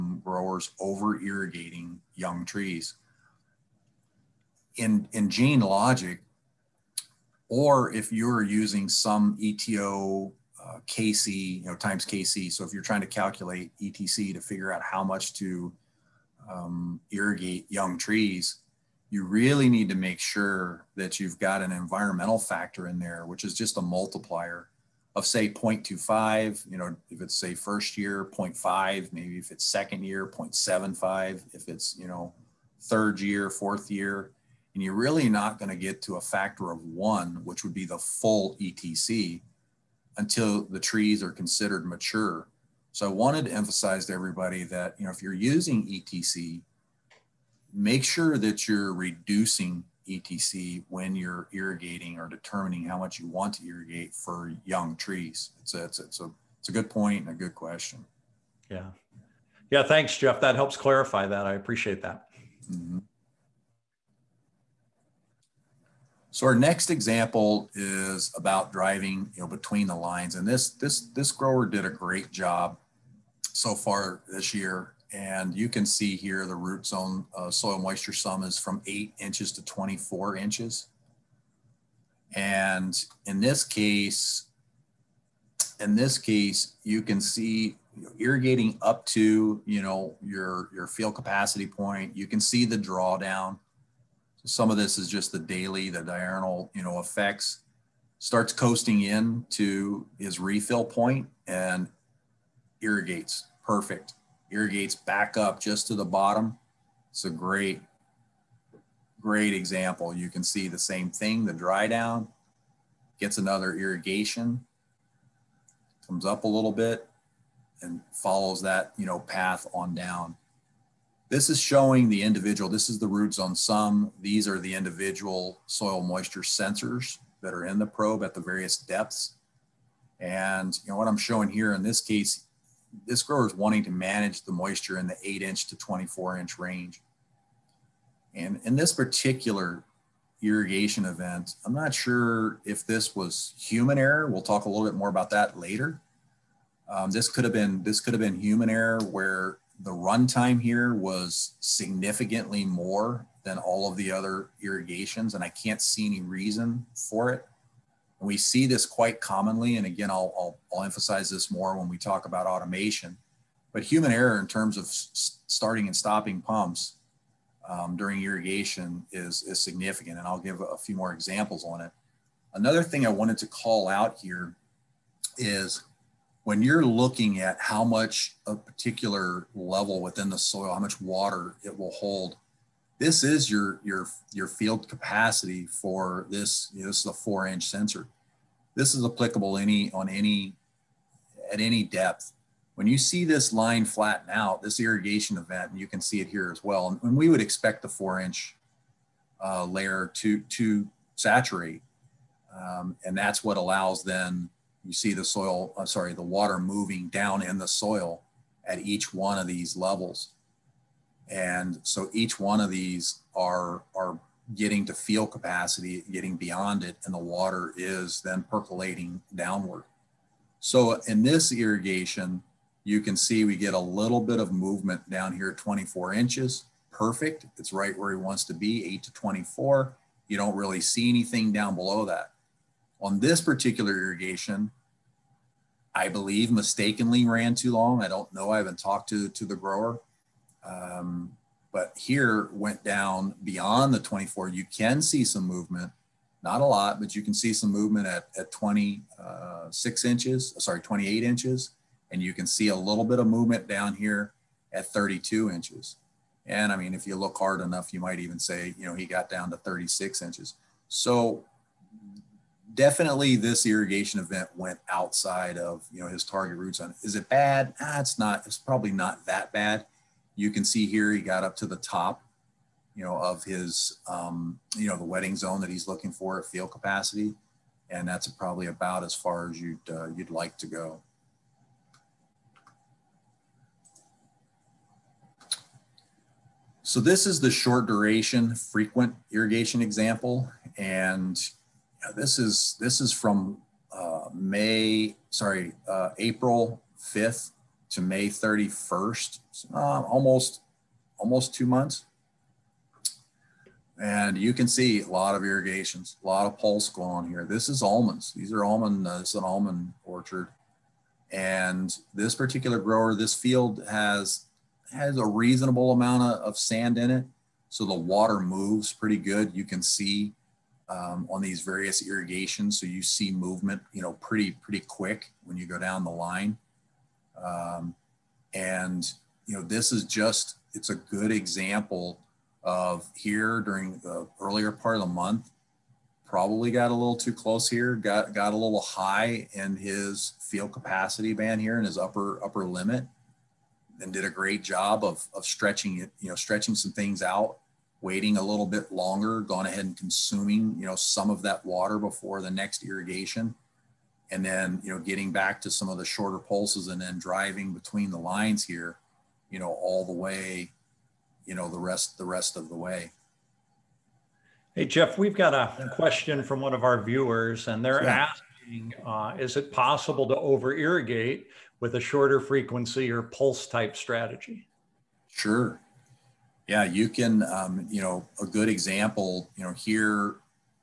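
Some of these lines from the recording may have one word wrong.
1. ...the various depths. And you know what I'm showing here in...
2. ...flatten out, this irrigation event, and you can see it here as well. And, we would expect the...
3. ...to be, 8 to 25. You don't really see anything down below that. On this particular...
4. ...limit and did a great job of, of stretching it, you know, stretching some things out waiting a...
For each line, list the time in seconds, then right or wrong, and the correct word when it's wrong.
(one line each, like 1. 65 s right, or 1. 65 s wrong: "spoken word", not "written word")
1. 128 s right
2. 193 s right
3. 228 s wrong: "24", not "25"
4. 342 s right.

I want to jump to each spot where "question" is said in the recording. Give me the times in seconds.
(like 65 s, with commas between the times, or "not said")
57 s, 365 s.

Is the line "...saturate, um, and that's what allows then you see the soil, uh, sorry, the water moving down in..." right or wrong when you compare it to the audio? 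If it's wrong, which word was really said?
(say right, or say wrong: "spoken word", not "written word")
right.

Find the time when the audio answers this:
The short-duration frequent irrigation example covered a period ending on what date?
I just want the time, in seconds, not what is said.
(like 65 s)
298 s.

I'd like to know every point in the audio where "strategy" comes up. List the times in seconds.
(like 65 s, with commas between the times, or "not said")
373 s.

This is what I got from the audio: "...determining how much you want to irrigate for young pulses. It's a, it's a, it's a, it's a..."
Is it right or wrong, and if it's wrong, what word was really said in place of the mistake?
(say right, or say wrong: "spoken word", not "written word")
wrong: "trees", not "pulses".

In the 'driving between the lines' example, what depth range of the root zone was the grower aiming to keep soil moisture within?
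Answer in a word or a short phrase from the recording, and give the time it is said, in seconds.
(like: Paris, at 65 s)
8 to 24 inches, at 135 s.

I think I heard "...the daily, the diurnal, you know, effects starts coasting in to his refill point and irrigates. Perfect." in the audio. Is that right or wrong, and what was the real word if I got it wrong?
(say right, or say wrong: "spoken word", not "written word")
right.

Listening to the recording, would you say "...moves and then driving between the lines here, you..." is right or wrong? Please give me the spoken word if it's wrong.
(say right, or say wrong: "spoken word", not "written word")
wrong: "pulses", not "moves".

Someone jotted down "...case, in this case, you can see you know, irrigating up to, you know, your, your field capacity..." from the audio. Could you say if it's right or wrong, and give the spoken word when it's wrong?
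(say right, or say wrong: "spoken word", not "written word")
right.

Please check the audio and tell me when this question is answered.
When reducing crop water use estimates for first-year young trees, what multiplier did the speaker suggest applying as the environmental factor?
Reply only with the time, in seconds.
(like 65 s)
25 s.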